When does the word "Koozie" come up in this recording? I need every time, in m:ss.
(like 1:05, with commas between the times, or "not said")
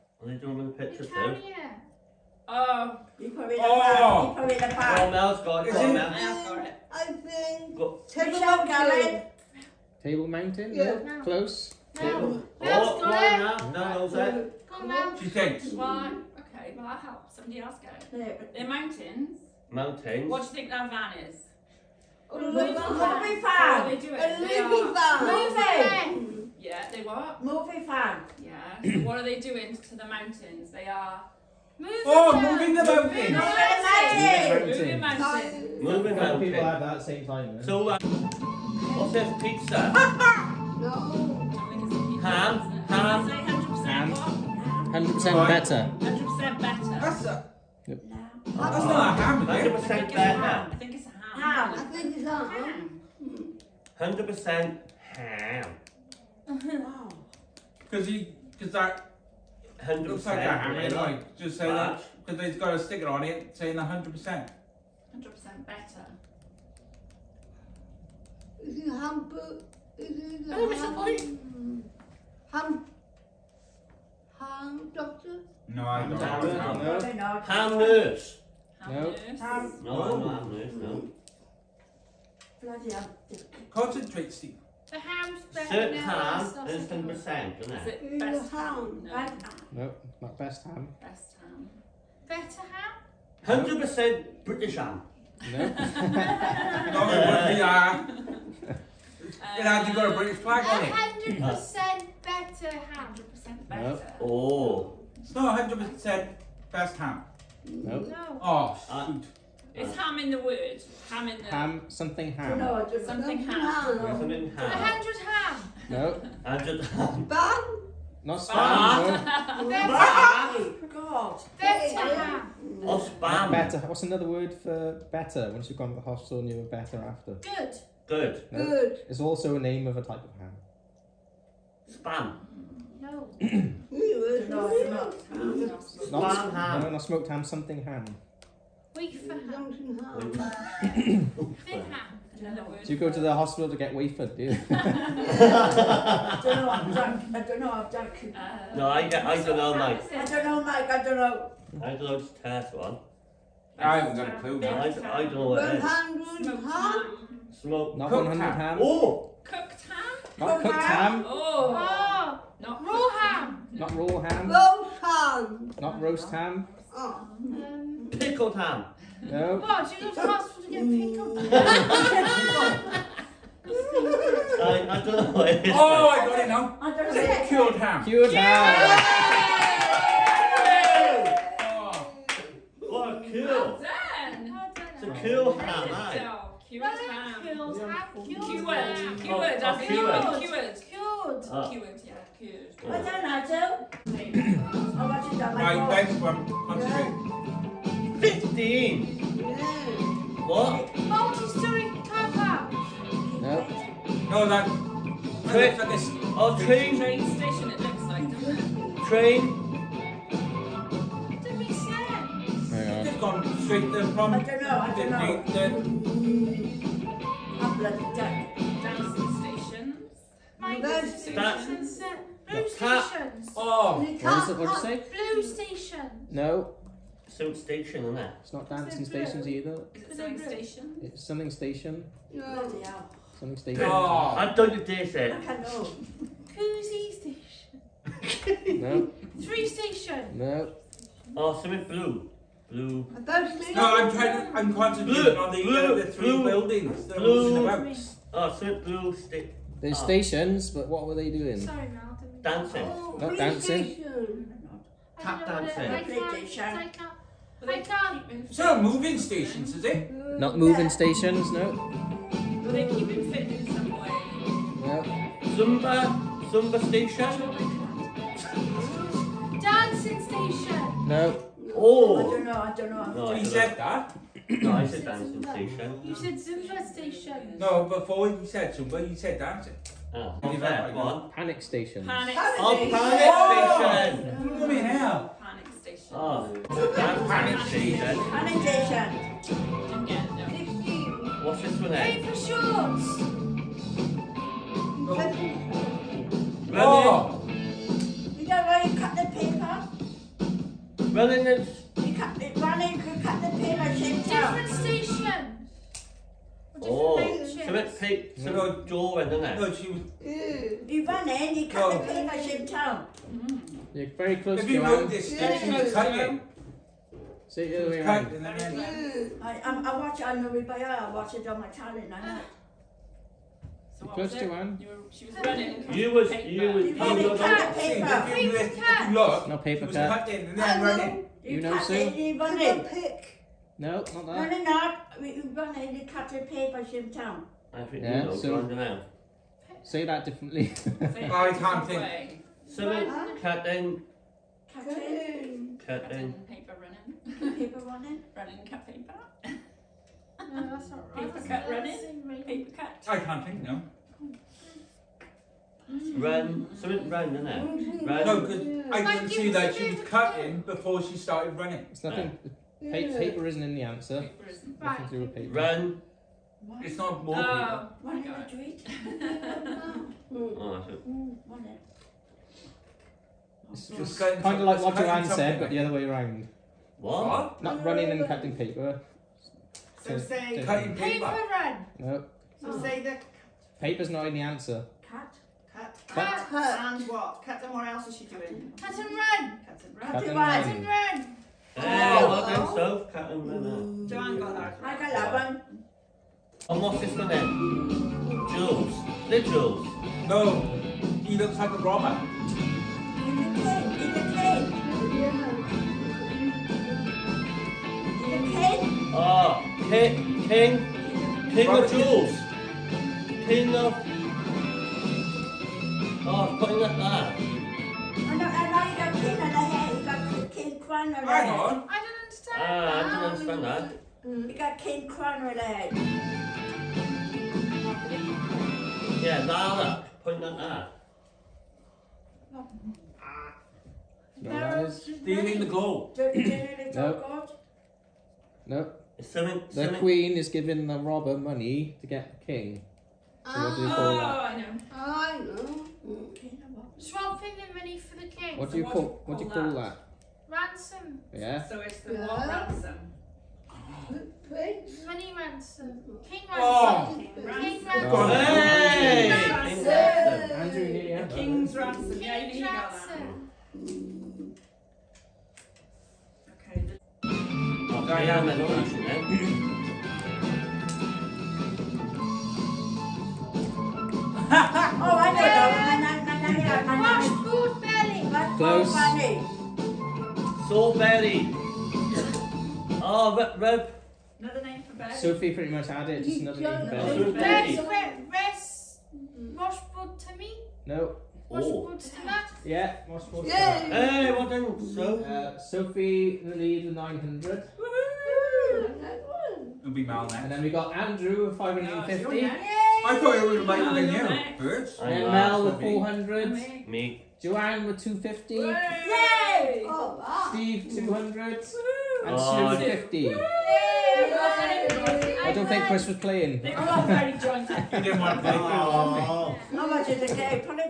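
3:56.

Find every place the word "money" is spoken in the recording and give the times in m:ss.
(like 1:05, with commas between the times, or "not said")
7:21, 7:27, 7:35.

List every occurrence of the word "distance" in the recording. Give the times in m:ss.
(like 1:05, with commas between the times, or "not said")
not said.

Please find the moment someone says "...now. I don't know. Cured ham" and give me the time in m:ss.
2:56.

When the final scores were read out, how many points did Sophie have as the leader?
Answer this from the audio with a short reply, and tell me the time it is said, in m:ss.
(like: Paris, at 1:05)
900, at 8:16.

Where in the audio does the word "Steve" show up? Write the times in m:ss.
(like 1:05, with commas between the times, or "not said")
1:24, 8:30.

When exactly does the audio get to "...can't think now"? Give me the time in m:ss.
5:53.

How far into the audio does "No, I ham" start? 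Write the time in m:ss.
1:52.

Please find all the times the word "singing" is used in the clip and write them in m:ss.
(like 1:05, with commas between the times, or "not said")
not said.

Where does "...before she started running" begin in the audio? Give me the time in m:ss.
6:00.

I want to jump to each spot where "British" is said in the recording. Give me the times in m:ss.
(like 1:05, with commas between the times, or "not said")
1:34, 1:40.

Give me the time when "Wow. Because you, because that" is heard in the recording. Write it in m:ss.
0:56.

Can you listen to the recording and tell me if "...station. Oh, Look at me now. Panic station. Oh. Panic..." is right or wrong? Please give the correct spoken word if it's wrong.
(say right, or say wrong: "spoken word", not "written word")
right.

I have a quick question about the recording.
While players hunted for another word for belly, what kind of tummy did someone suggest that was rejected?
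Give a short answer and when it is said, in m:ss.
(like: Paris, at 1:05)
Washboard tummy, at 8:09.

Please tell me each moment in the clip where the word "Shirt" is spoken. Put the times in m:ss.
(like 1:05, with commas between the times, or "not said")
1:25.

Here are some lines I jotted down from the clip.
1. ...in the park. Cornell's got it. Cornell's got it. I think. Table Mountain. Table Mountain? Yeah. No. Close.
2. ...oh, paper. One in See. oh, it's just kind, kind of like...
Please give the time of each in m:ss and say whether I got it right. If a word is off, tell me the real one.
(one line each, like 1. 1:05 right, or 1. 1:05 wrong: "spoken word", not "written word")
1. 0:04 right
2. 6:07 wrong: "Madrid", not "See".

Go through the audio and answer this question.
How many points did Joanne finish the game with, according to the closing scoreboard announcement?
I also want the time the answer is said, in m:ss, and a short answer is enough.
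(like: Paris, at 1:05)
250, at 8:28.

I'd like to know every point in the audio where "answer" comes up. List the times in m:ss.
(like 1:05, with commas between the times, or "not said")
6:03, 6:24.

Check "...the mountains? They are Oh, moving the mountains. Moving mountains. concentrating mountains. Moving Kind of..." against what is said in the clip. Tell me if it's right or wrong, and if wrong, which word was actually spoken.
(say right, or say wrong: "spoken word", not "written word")
wrong: "moving", not "concentrating".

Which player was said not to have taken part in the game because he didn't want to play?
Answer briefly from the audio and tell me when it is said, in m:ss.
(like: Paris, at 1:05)
Chris, at 8:35.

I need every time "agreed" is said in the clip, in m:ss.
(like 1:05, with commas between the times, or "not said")
not said.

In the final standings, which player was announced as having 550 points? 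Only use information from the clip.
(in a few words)
Andrew.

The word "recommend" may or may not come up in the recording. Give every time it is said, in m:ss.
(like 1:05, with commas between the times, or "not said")
not said.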